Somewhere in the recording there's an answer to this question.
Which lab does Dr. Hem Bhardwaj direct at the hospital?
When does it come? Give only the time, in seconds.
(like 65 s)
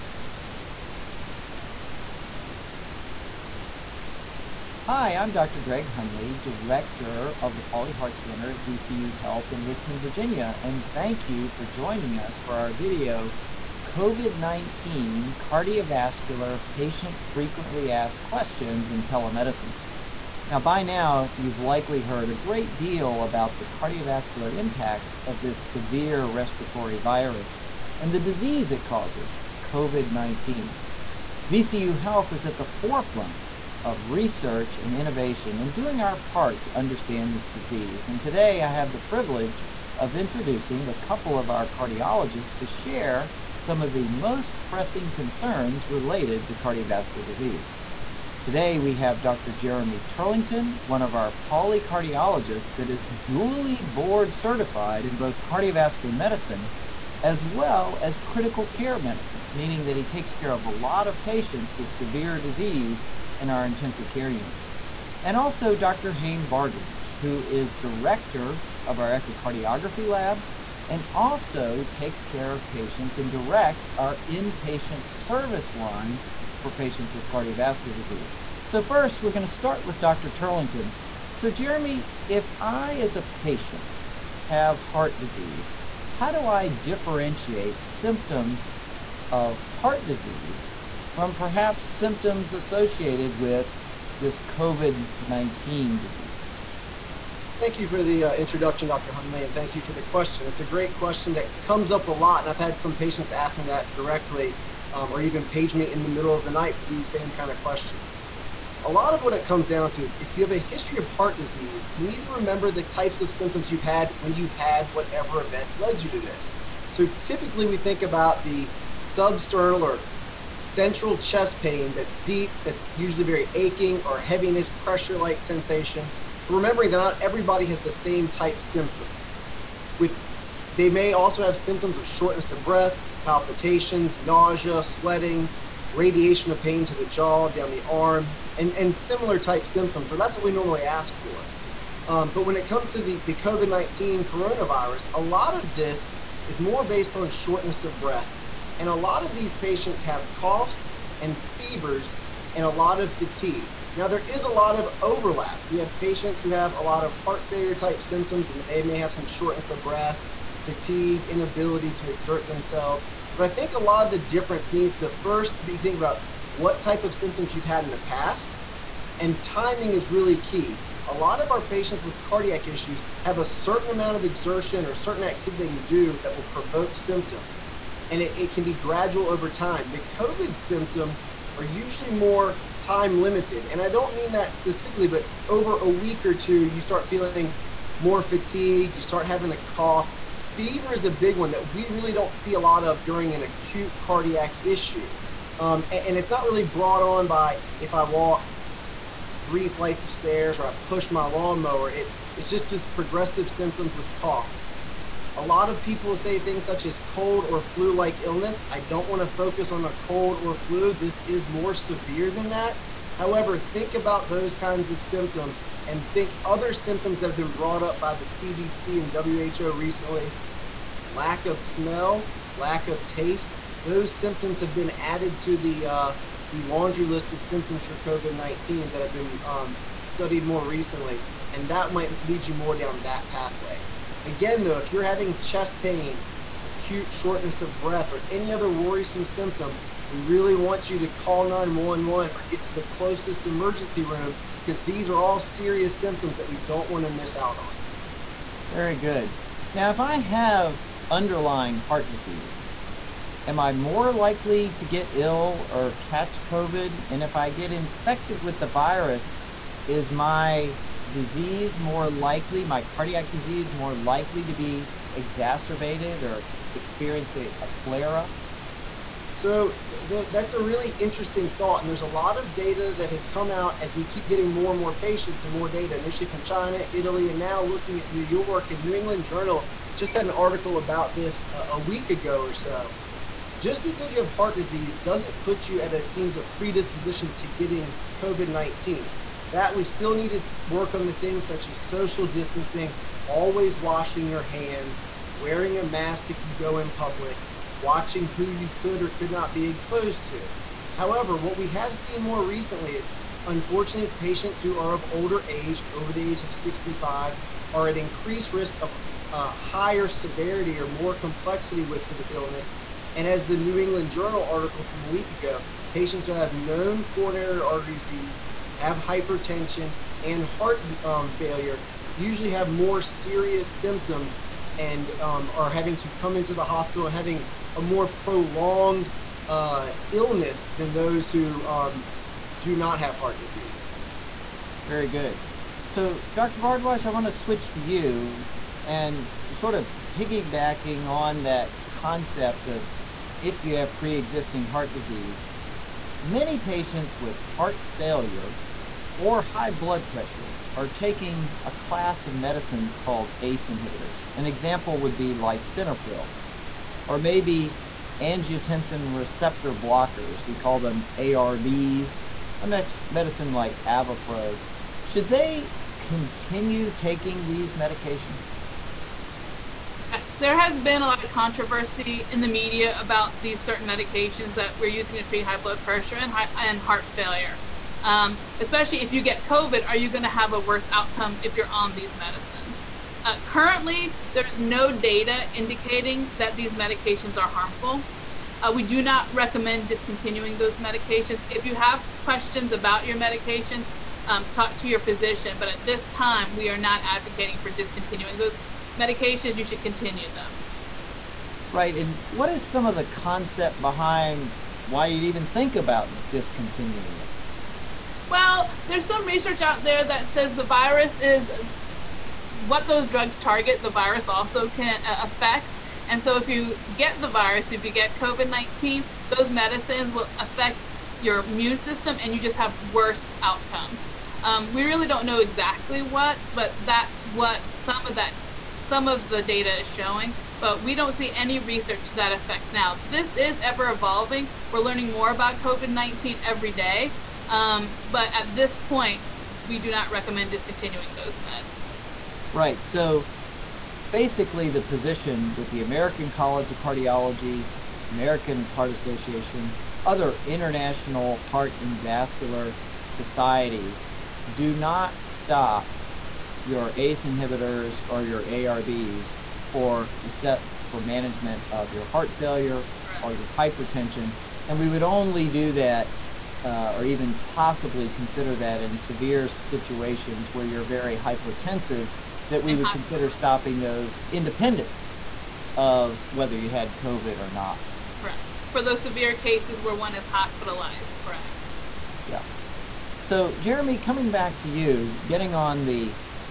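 69 s.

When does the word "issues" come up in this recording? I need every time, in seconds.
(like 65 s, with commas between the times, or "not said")
172 s, 194 s.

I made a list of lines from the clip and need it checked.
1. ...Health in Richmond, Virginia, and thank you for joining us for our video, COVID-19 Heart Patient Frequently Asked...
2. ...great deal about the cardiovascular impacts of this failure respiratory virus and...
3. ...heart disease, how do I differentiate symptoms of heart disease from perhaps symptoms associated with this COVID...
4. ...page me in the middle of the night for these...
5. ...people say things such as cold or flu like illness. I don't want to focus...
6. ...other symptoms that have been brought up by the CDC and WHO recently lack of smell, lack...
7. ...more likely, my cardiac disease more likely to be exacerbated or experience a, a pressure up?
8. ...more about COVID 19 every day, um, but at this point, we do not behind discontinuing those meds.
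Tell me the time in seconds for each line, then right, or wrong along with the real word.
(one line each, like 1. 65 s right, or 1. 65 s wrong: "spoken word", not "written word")
1. 9 s wrong: "Cardiovascular", not "Heart"
2. 22 s wrong: "severe", not "failure"
3. 84 s right
4. 105 s right
5. 205 s right
6. 216 s right
7. 261 s wrong: "flare", not "pressure"
8. 435 s wrong: "recommend", not "behind".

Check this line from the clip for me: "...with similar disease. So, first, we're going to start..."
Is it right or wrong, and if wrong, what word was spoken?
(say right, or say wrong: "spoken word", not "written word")
wrong: "cardiovascular", not "similar".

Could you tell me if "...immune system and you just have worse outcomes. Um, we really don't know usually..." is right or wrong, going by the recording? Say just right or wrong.
wrong.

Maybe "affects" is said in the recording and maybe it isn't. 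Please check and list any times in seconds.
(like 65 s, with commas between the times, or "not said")
415 s, 420 s.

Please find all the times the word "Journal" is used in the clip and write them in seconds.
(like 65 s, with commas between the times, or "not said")
279 s, 314 s.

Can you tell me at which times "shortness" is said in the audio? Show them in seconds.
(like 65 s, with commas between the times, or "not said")
132 s, 147 s, 159 s, 237 s.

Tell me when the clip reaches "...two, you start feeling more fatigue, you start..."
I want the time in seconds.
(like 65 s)
186 s.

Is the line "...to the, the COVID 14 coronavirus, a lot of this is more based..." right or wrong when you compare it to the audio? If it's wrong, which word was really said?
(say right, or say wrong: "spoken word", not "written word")
wrong: "19", not "14".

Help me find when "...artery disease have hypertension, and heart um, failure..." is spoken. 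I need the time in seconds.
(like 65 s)
317 s.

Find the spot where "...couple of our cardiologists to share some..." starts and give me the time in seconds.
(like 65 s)
40 s.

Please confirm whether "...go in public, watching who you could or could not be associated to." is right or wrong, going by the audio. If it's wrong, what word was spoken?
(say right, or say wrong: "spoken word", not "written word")
wrong: "exposed", not "associated".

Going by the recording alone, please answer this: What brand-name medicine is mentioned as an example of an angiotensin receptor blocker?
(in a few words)
Avapro.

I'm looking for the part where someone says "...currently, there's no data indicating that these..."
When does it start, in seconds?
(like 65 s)
383 s.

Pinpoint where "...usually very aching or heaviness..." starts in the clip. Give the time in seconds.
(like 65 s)
122 s.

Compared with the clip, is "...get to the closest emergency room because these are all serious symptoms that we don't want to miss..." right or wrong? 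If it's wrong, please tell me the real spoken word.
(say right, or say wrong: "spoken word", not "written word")
right.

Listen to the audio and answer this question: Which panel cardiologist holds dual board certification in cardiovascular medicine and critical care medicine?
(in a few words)
Jeremy Turlington.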